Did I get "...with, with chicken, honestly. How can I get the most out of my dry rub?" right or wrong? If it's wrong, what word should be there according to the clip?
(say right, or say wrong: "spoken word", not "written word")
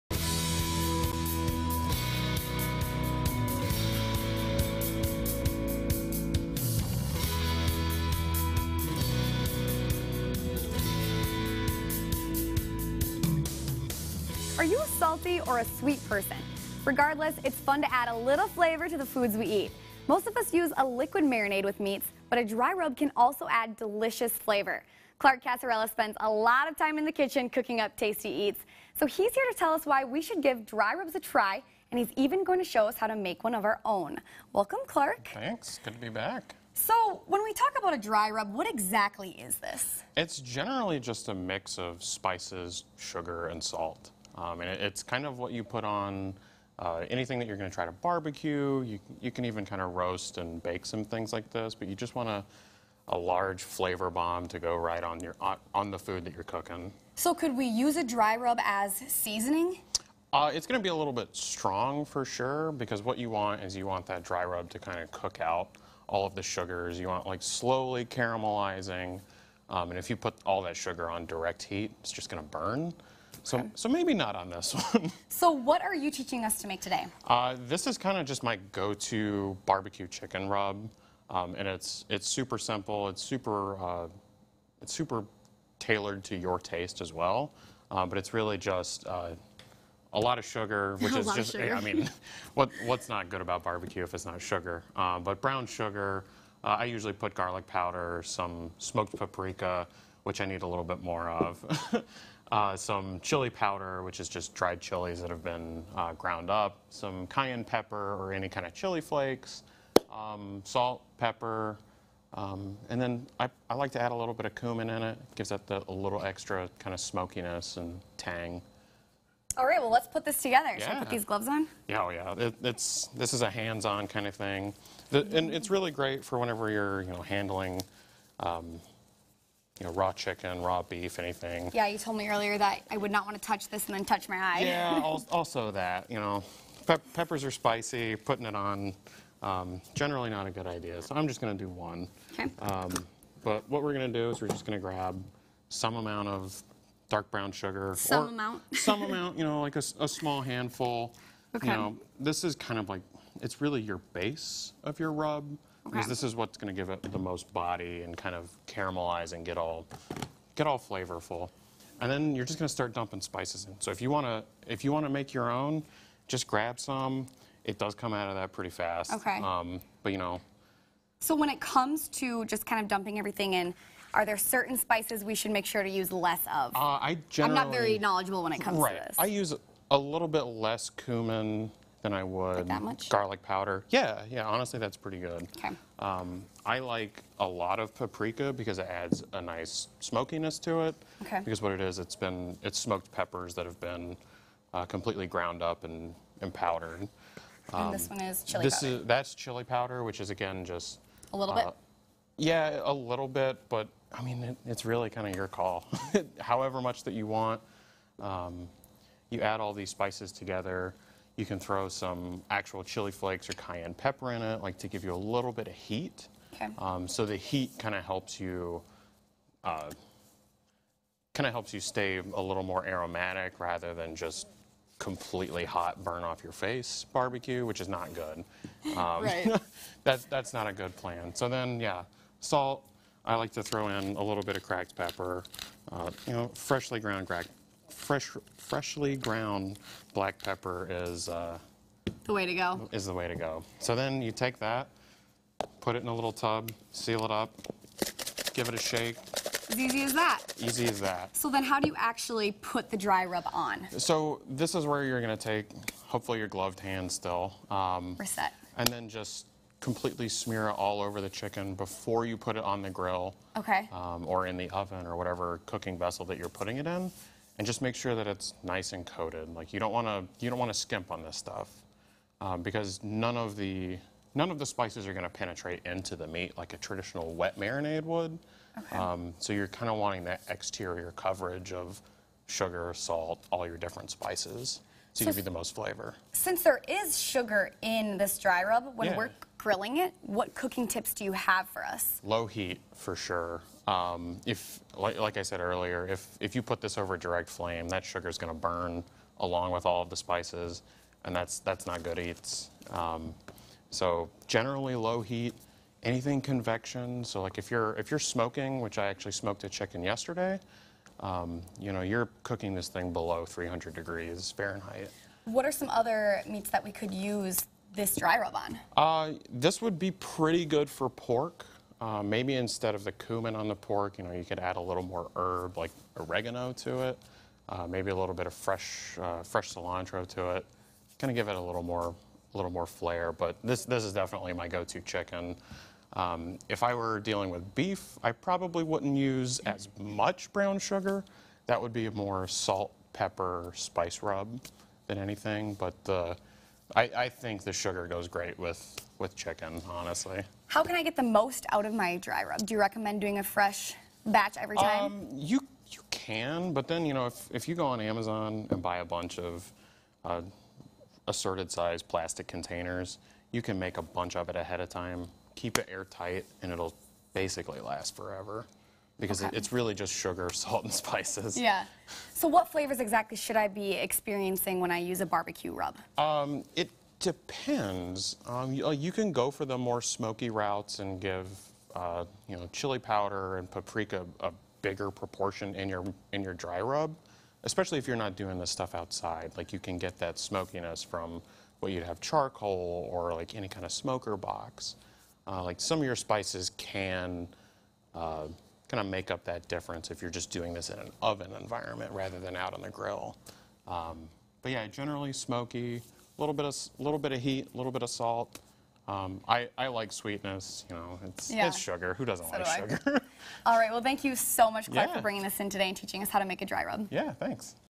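right.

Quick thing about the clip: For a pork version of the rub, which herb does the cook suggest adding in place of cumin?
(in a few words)
oregano.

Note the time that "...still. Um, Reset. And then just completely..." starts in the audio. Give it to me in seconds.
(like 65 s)
257 s.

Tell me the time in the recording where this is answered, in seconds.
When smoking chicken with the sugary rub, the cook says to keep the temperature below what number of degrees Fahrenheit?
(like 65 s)
313 s.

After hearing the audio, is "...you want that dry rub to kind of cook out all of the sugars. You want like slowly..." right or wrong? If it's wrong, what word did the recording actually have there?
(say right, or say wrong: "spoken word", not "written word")
right.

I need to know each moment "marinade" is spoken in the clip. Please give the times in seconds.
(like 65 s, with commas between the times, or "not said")
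21 s, 277 s.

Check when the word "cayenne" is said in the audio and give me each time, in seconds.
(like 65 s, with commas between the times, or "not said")
107 s, 213 s.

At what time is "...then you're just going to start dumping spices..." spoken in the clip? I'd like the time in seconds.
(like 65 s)
162 s.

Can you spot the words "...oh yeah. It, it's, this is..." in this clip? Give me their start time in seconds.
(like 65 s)
122 s.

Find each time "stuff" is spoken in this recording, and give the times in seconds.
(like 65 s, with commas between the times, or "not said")
271 s, 388 s.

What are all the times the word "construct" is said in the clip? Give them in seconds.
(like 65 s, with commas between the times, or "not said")
not said.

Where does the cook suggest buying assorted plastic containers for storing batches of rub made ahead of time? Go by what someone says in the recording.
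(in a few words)
Amazon.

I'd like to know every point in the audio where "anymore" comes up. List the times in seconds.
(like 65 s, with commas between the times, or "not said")
not said.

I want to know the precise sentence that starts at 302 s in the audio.
Um, so generally low heat, anything convection.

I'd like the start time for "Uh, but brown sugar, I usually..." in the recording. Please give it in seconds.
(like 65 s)
94 s.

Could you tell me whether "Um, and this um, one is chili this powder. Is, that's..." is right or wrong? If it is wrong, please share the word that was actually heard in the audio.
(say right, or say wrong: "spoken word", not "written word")
right.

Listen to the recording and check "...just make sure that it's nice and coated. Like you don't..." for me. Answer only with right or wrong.
right.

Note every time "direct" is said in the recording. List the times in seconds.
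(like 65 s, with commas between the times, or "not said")
71 s, 297 s.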